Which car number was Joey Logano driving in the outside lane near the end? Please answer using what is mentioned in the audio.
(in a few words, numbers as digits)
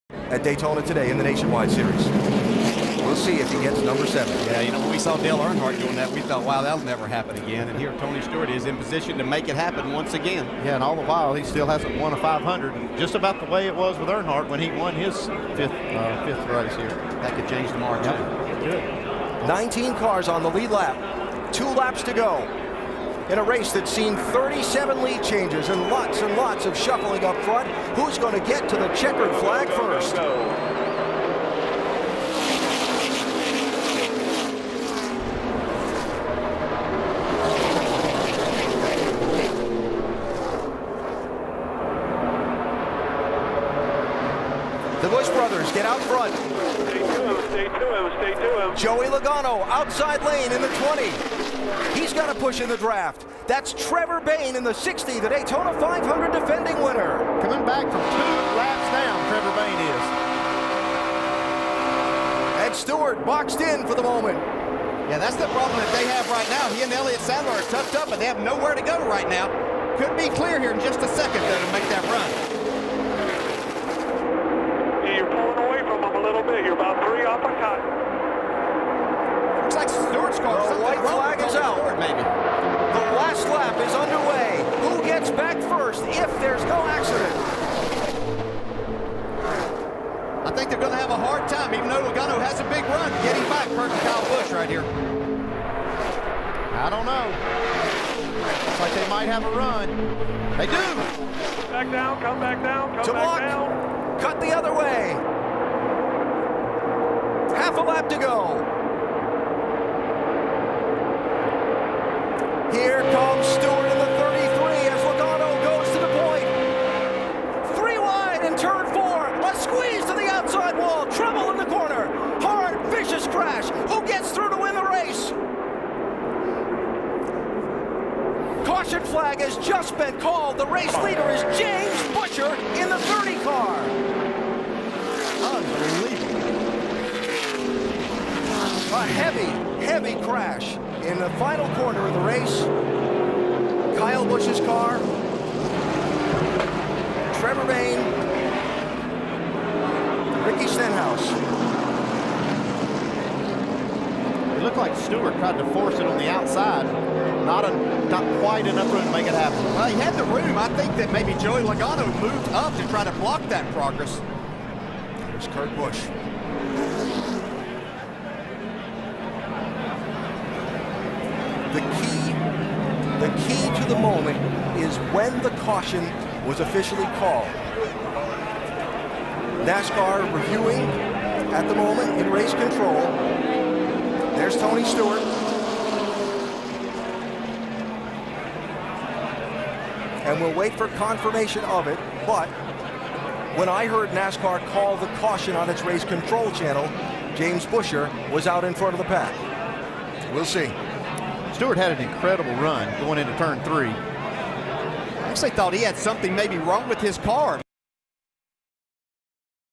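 20.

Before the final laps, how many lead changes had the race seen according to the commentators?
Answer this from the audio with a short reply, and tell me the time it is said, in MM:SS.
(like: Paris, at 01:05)
37, at 00:24.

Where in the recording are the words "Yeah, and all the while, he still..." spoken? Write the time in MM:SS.
00:10.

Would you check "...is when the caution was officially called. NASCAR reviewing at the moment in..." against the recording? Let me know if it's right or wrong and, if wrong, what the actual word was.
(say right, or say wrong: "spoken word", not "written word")
right.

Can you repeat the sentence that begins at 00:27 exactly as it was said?
Who's going to get to the checkered flag first?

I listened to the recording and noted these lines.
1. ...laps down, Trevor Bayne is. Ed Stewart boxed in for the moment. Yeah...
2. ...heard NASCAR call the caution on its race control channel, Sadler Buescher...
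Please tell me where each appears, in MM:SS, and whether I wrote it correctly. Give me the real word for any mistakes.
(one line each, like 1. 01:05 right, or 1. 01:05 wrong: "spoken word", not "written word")
1. 00:58 right
2. 03:13 wrong: "James", not "Sadler".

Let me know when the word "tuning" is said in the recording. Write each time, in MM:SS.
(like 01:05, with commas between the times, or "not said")
not said.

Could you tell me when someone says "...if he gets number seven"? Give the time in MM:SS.
00:03.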